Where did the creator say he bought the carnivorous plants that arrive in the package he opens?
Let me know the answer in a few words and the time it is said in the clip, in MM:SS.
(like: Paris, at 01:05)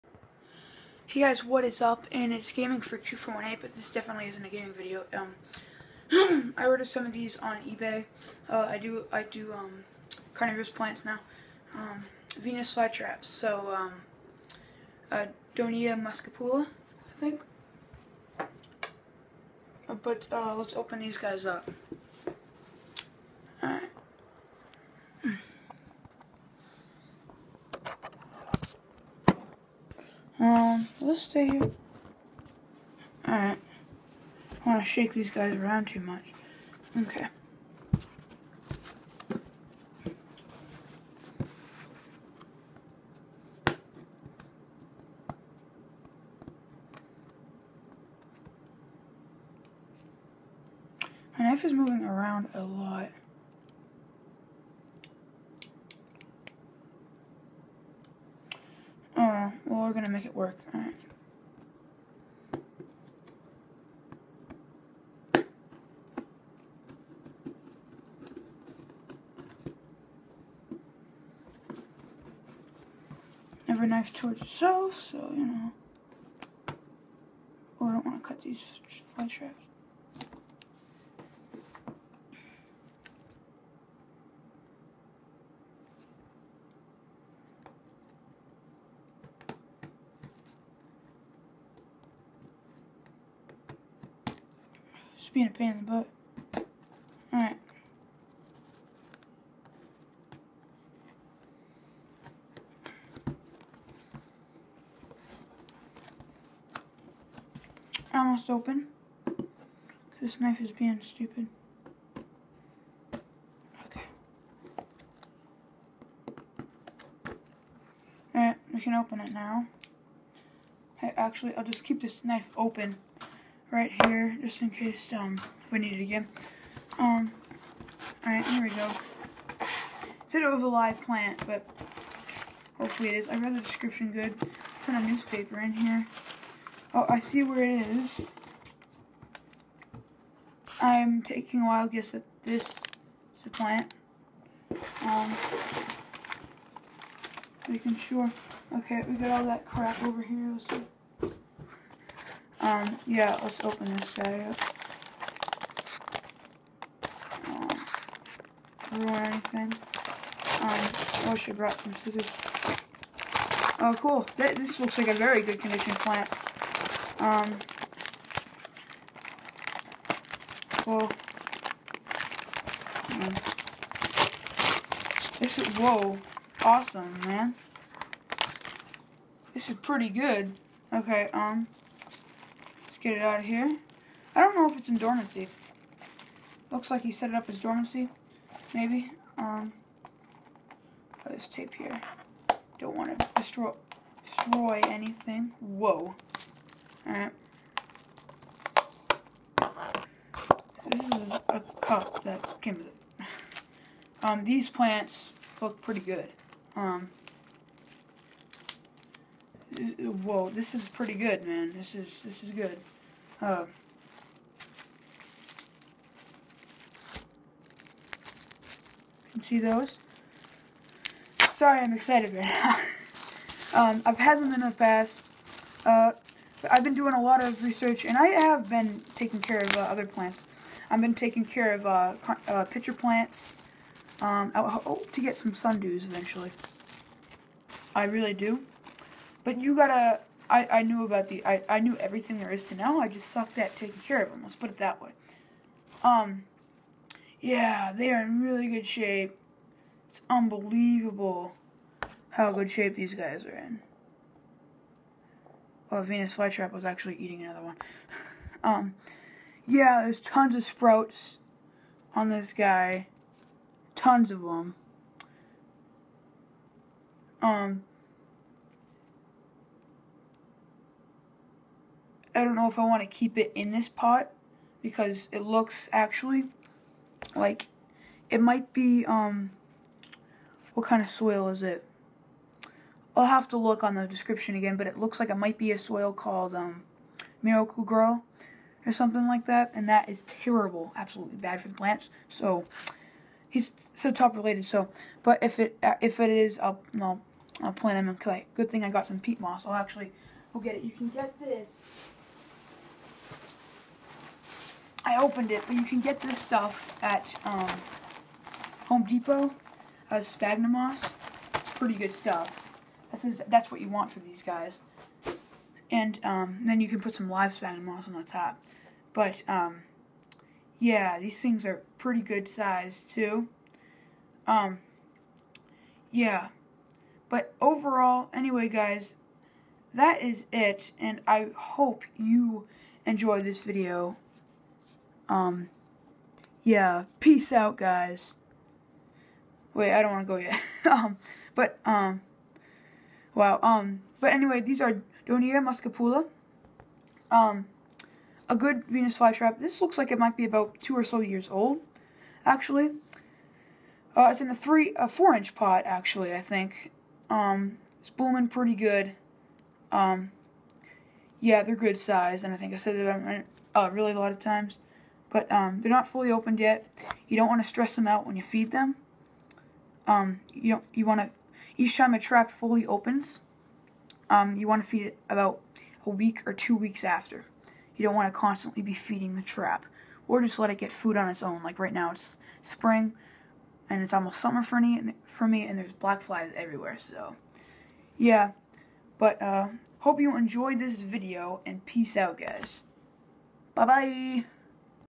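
eBay, at 00:07.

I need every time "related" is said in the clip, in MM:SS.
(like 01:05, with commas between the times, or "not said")
04:54.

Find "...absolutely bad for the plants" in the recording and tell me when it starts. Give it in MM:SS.
04:50.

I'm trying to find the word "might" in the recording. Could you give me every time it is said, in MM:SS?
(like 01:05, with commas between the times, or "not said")
04:38, 04:45, 05:50.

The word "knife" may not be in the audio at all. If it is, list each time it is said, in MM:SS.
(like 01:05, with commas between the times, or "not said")
00:51, 01:13, 01:50, 02:02.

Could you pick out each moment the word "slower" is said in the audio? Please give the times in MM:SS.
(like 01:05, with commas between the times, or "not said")
not said.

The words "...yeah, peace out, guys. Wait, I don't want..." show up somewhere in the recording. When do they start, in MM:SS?
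05:36.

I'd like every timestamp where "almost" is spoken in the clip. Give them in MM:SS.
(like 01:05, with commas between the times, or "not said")
01:48, 06:24.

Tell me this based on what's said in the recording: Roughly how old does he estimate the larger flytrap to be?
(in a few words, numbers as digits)
2 years.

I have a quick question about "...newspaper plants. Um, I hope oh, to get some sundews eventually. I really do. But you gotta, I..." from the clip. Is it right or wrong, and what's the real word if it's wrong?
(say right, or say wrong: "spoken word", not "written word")
wrong: "pitcher", not "newspaper".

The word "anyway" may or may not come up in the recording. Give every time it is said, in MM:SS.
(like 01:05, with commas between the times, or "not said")
05:28, 05:44.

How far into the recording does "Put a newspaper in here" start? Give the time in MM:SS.
02:14.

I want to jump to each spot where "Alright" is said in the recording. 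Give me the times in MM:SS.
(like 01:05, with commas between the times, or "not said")
00:33, 01:37, 01:58, 02:08, 03:17.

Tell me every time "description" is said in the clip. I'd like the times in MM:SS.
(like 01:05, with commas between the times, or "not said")
02:13, 04:44.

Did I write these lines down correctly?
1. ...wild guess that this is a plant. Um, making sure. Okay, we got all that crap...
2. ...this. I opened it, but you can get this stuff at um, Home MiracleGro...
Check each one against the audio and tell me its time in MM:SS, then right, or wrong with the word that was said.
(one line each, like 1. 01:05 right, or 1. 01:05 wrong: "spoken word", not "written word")
1. 02:21 right
2. 05:01 wrong: "Depot", not "MiracleGro".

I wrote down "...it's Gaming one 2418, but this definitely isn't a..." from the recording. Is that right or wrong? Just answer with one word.
right.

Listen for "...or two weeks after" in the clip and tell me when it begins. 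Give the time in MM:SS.
06:16.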